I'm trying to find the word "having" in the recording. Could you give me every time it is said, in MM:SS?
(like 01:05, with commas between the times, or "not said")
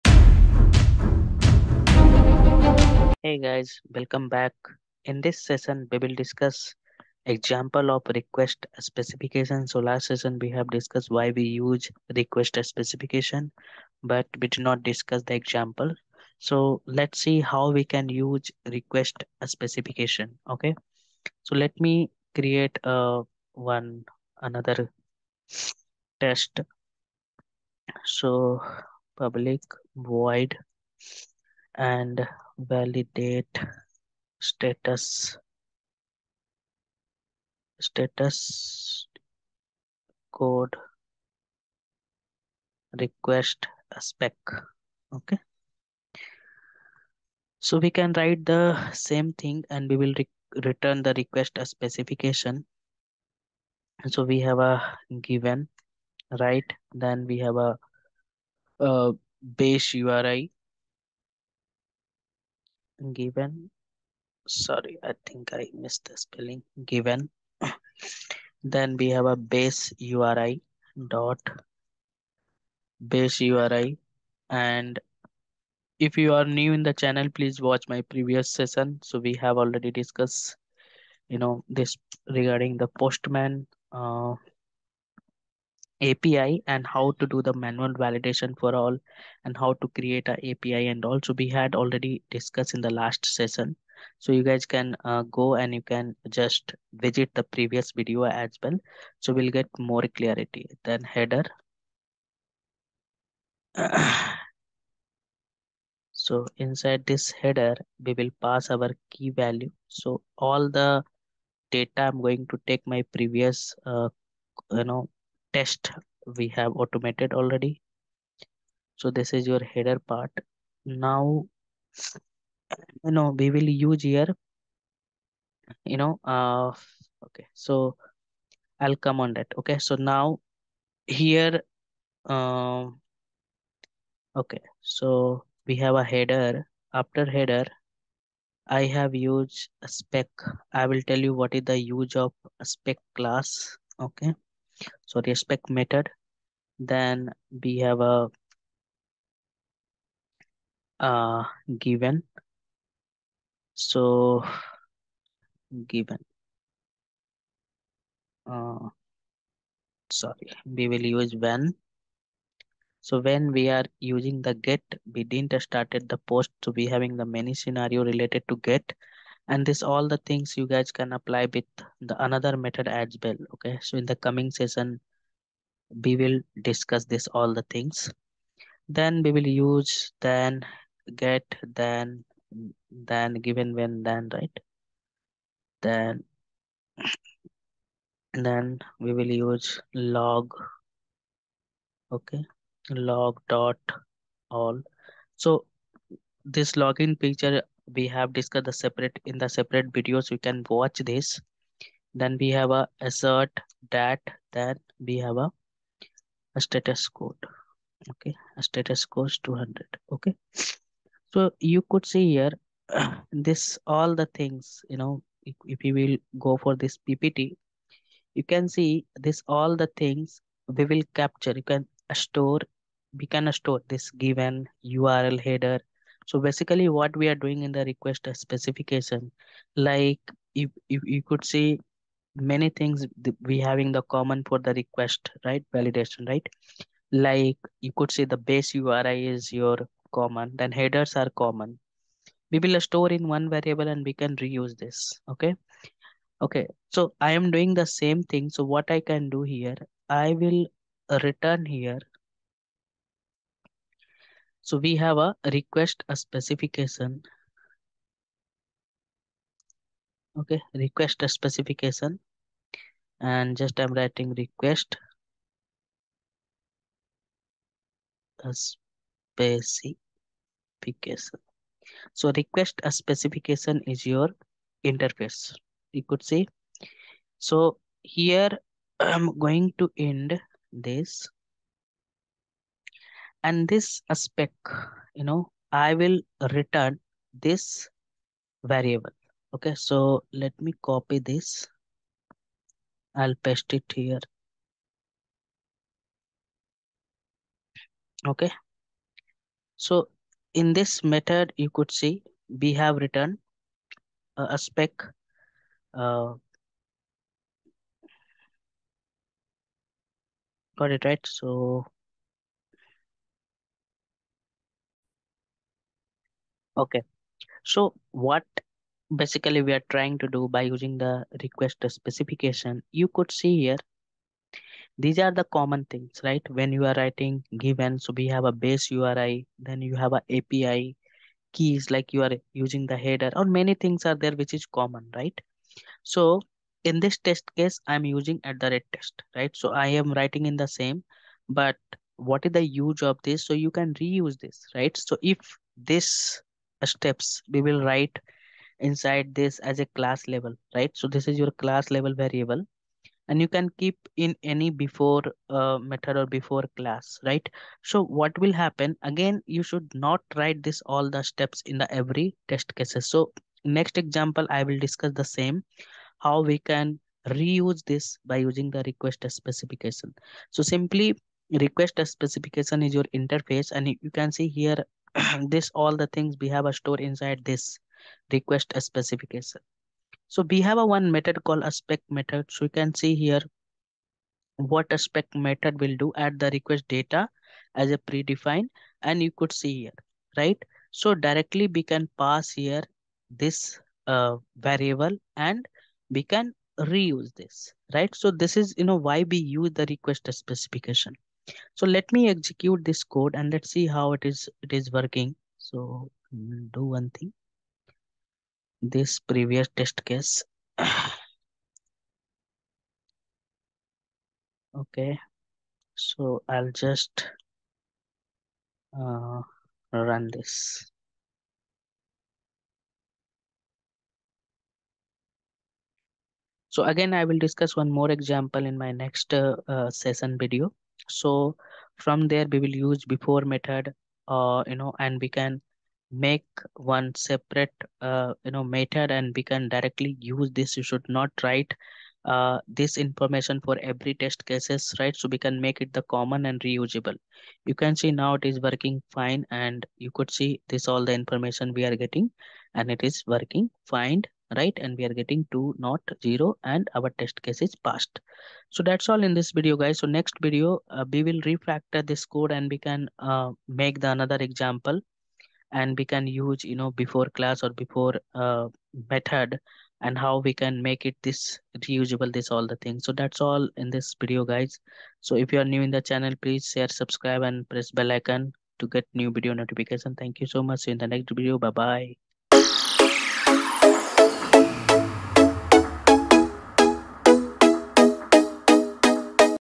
02:46, 03:53.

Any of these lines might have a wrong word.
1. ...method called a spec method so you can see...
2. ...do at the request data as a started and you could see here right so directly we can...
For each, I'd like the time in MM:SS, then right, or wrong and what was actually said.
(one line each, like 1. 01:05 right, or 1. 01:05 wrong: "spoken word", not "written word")
1. 06:21 right
2. 06:25 wrong: "predefined", not "started".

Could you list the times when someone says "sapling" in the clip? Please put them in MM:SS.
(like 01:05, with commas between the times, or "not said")
not said.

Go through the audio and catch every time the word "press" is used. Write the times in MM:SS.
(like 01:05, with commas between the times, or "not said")
07:57.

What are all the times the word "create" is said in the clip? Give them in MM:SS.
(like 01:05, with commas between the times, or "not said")
00:22, 01:29.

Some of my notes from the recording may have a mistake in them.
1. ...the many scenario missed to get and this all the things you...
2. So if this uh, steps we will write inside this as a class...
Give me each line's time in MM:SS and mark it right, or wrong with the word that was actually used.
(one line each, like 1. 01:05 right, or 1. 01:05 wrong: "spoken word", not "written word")
1. 02:47 wrong: "related", not "missed"
2. 05:44 right.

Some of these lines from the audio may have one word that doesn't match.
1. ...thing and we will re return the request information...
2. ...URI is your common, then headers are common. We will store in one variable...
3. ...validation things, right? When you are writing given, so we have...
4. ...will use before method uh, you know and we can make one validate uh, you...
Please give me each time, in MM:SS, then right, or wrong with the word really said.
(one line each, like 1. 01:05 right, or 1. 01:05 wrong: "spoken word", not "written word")
1. 00:49 wrong: "specification", not "information"
2. 03:58 right
3. 05:25 wrong: "common", not "validation"
4. 07:12 wrong: "separate", not "validate".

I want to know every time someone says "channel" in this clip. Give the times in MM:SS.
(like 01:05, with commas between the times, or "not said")
01:17, 07:56.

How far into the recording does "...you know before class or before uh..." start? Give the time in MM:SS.
07:46.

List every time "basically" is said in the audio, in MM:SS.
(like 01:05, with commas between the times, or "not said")
03:46, 05:19.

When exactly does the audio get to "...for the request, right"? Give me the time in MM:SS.
03:54.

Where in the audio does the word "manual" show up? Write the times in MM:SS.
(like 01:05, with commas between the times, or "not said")
01:27.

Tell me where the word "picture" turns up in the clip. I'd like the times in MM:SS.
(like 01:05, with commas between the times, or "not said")
03:17.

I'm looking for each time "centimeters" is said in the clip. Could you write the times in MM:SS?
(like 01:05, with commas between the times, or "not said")
not said.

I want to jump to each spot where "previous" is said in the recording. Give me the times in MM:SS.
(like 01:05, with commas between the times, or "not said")
01:18, 01:37, 01:53, 06:49.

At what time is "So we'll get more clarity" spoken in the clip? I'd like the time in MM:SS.
01:39.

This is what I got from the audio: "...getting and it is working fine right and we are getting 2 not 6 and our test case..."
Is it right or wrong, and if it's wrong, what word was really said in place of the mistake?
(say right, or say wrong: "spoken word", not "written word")
wrong: "0", not "6".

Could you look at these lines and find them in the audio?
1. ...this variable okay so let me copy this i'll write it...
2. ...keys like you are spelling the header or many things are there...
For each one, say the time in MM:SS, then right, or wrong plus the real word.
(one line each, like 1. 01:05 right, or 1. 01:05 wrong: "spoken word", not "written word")
1. 04:47 wrong: "paste", not "write"
2. 05:31 wrong: "using", not "spelling".